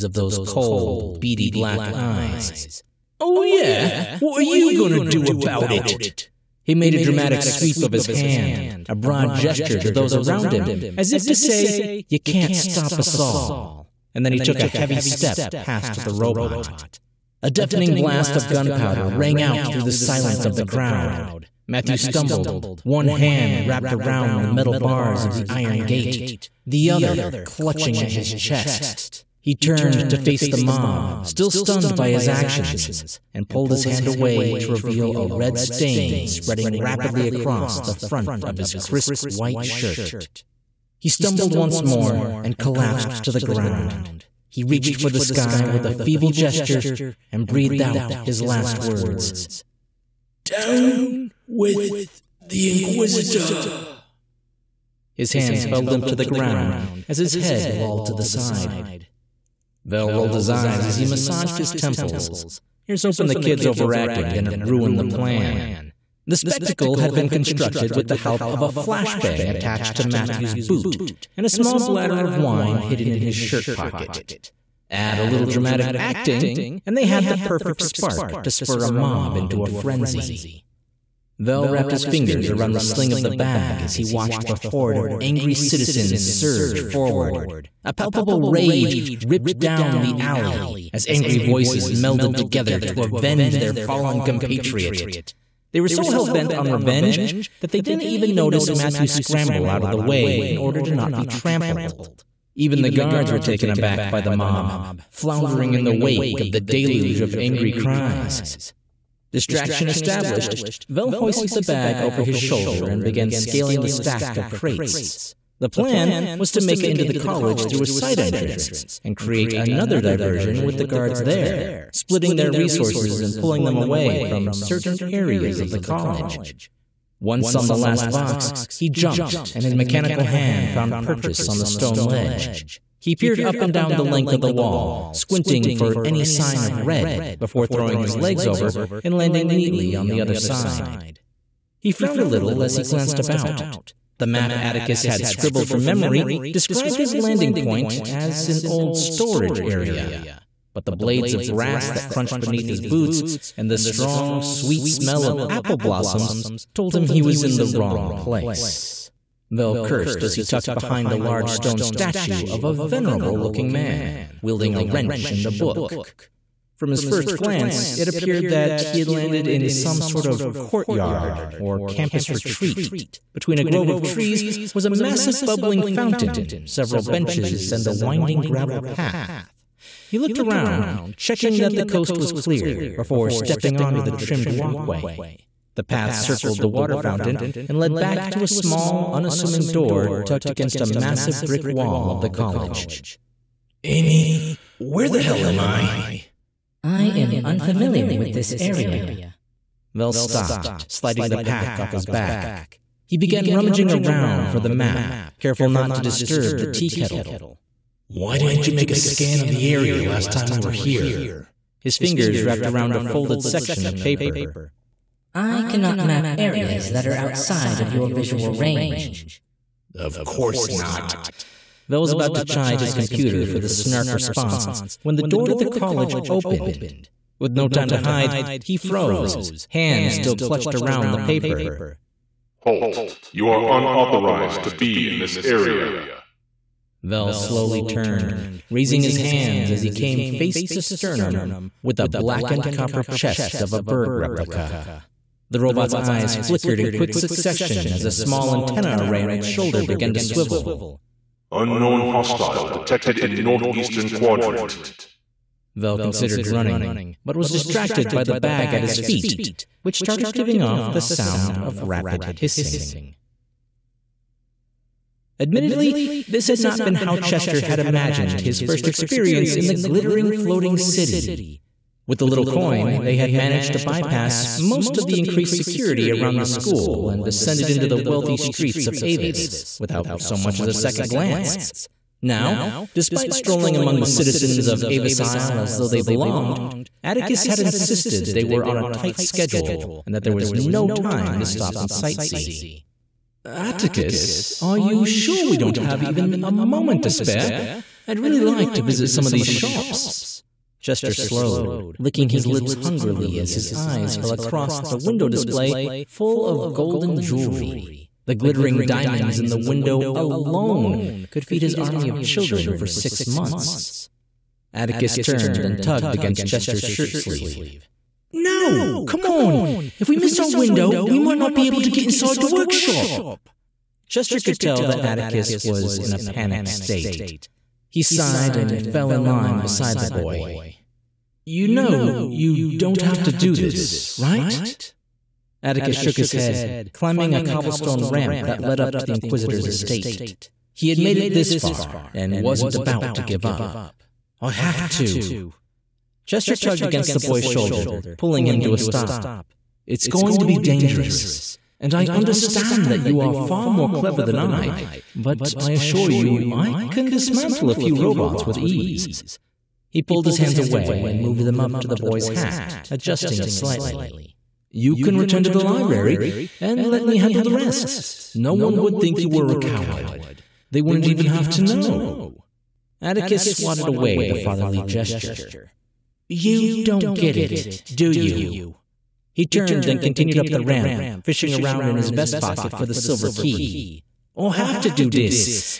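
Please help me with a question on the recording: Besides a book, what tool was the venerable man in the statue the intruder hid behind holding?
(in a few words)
A wrench.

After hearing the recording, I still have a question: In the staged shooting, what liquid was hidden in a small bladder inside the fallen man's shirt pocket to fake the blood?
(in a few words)
Wine.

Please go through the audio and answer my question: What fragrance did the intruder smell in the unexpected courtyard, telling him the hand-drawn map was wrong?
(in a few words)
Apple blossoms.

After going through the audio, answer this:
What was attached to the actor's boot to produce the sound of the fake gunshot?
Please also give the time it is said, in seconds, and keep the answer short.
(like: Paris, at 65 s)
A flashbang, at 68 s.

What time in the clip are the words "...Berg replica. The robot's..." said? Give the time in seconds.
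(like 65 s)
243 s.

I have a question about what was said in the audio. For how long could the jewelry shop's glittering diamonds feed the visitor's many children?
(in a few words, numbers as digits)
6 months.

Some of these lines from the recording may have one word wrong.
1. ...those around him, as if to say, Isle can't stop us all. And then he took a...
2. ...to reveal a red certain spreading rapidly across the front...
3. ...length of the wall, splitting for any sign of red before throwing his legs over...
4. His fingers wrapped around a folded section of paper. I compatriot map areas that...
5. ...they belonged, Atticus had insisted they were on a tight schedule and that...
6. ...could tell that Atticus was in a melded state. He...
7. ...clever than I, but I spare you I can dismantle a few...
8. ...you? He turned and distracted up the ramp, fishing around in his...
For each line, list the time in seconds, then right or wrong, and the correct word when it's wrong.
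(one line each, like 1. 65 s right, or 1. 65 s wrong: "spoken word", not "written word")
1. 9 s wrong: "You", not "Isle"
2. 34 s wrong: "stain", not "certain"
3. 134 s wrong: "squinting", not "splitting"
4. 211 s wrong: "cannot", not "compatriot"
5. 285 s right
6. 324 s wrong: "panicked", not "melded"
7. 353 s wrong: "assure", not "spare"
8. 378 s wrong: "continued", not "distracted".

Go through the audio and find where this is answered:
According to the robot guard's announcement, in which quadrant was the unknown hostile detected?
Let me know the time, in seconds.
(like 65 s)
253 s.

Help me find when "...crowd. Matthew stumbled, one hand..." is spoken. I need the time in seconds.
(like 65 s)
20 s.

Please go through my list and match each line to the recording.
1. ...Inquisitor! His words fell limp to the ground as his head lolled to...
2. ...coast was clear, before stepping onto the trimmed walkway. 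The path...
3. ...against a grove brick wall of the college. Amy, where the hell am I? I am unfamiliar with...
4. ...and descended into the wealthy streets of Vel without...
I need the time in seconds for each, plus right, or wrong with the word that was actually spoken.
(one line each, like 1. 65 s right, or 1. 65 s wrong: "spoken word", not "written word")
1. 52 s wrong: "hands", not "words"
2. 181 s right
3. 190 s wrong: "massive", not "grove"
4. 277 s wrong: "Avis", not "Vel".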